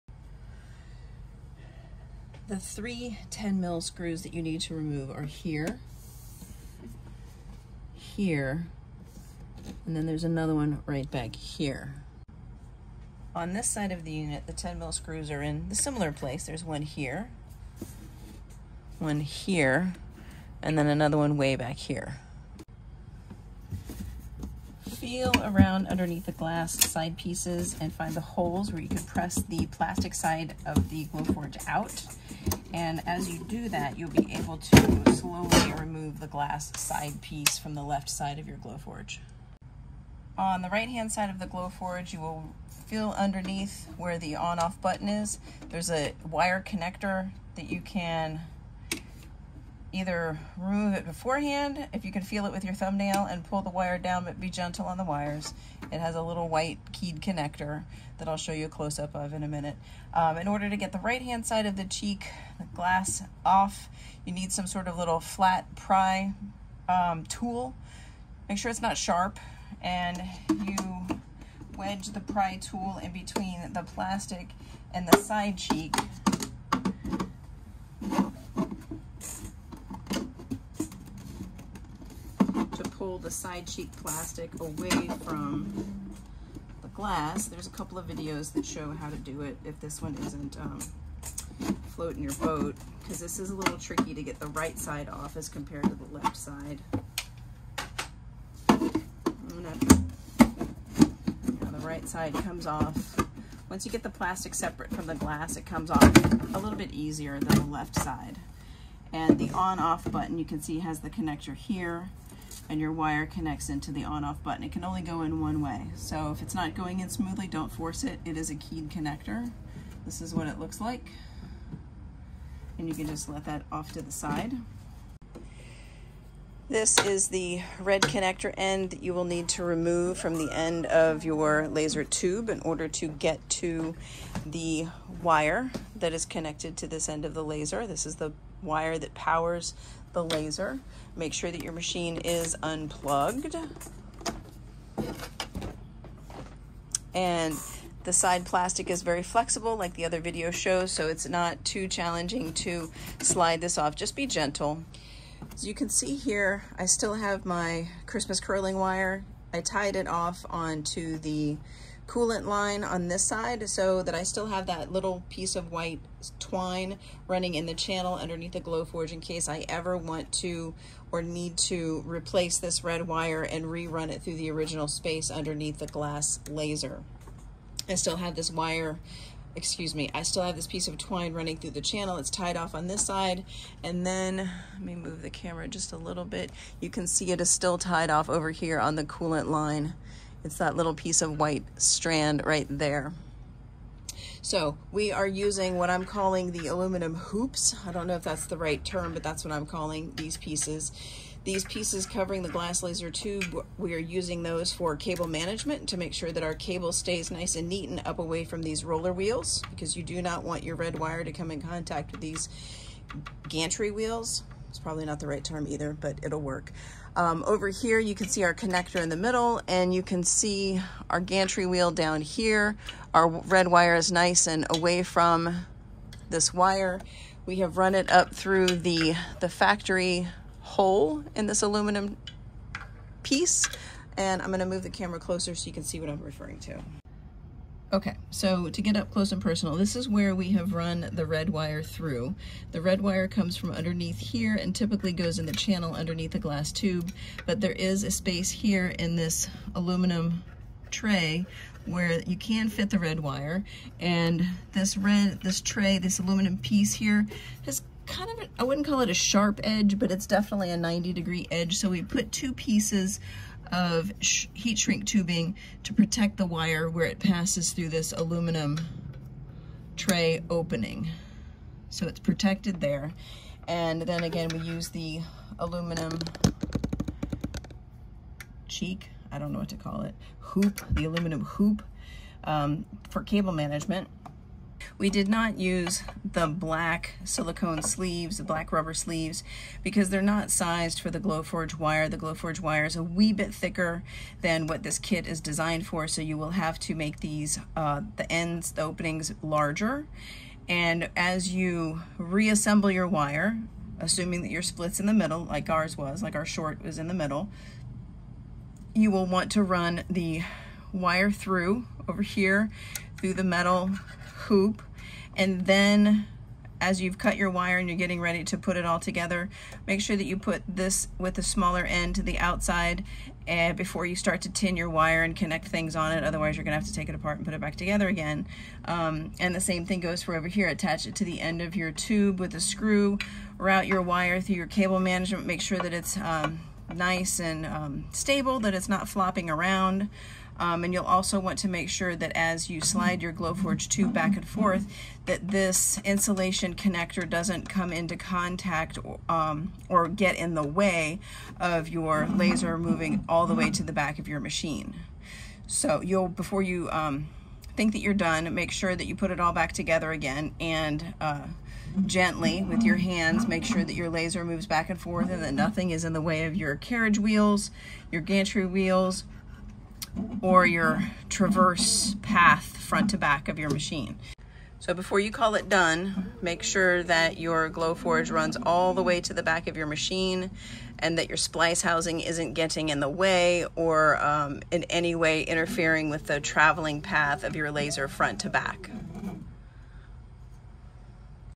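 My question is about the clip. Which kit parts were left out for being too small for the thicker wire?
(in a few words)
Black silicone sleeves.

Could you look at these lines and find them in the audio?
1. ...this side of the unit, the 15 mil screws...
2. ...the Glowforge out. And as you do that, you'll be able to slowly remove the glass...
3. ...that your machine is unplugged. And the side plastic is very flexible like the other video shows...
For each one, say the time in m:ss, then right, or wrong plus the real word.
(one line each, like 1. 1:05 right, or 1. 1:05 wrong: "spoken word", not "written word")
1. 0:13 wrong: "10", not "15"
2. 0:30 right
3. 2:21 right.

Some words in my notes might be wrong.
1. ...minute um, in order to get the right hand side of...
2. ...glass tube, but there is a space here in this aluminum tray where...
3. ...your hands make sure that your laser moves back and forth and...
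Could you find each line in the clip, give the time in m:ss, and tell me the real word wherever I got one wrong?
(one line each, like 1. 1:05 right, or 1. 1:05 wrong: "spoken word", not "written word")
1. 0:59 right
2. 4:06 right
3. 6:02 right.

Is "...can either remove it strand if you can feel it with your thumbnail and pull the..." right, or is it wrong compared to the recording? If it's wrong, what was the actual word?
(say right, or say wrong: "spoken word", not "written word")
wrong: "beforehand", not "strand".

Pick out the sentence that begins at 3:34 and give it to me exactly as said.
It's probably not the right term either, but it'll work.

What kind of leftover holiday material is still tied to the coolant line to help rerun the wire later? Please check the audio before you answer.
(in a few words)
Christmas curling wire.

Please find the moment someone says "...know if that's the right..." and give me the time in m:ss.
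3:18.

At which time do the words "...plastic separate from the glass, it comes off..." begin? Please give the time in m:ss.
1:44.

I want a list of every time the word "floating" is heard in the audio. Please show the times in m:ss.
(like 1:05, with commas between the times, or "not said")
1:31.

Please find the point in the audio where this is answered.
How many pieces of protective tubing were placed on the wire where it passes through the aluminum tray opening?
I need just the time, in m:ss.
4:22.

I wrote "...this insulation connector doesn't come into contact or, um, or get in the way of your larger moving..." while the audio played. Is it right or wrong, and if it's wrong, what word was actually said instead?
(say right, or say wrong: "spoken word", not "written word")
wrong: "laser", not "larger".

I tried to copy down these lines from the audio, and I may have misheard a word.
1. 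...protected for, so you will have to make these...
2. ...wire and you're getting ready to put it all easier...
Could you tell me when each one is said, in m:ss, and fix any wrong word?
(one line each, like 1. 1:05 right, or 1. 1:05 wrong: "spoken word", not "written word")
1. 4:55 wrong: "designed", not "protected"
2. 5:17 wrong: "together", not "easier".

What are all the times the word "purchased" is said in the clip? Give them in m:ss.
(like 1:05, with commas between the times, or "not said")
not said.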